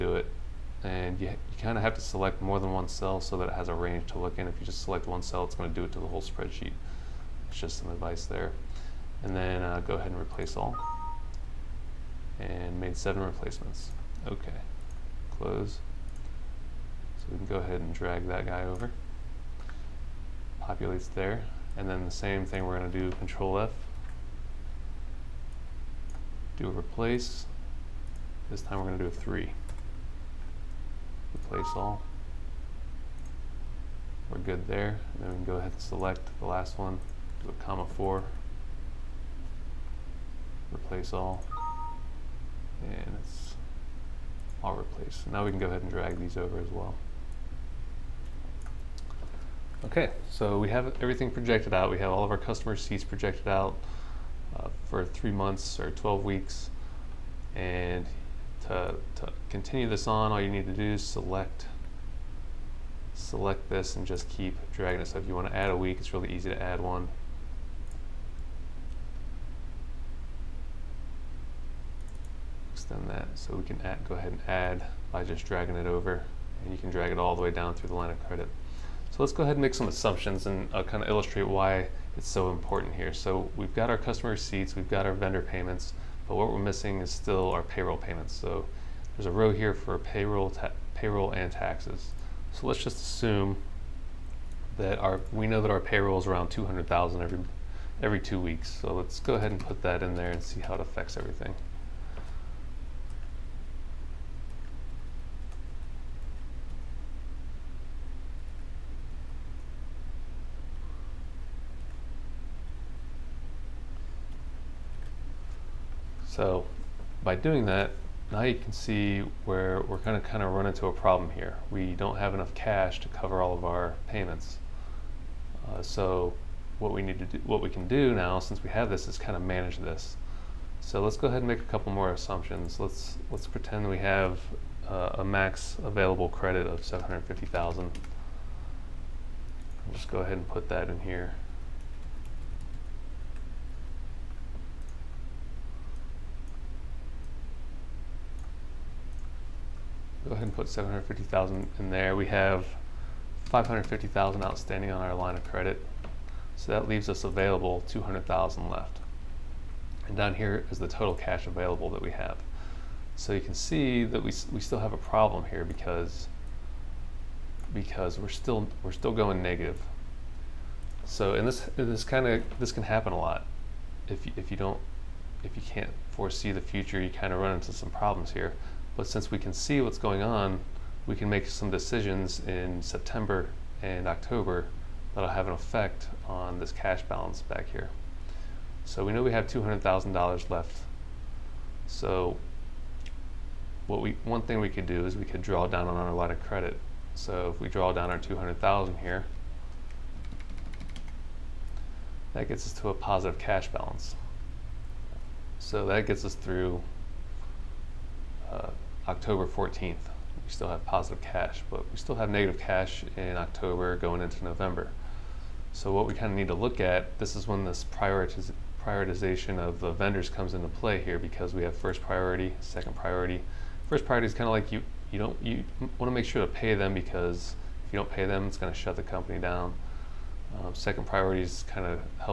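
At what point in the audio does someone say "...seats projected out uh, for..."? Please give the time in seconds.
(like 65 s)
52 s.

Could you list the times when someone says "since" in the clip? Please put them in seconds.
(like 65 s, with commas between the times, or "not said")
128 s, 179 s.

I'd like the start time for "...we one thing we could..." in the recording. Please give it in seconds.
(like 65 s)
194 s.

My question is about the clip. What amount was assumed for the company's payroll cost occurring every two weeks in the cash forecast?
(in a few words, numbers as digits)
200,000.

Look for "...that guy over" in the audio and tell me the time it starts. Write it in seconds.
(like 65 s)
18 s.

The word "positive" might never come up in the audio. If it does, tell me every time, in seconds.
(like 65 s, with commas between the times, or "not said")
202 s, 210 s.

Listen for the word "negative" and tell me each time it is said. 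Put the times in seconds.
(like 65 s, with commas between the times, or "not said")
169 s, 212 s.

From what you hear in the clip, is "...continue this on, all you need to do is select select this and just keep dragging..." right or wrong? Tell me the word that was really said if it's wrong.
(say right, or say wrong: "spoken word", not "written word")
right.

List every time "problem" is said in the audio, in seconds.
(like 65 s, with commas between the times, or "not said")
120 s, 164 s, 177 s.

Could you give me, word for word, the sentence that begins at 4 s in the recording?
If you just select one cell, it's going to do it to the whole spreadsheet.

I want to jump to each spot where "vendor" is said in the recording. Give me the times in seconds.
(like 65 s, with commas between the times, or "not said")
85 s, 219 s.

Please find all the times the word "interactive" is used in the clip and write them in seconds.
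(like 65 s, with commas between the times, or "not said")
not said.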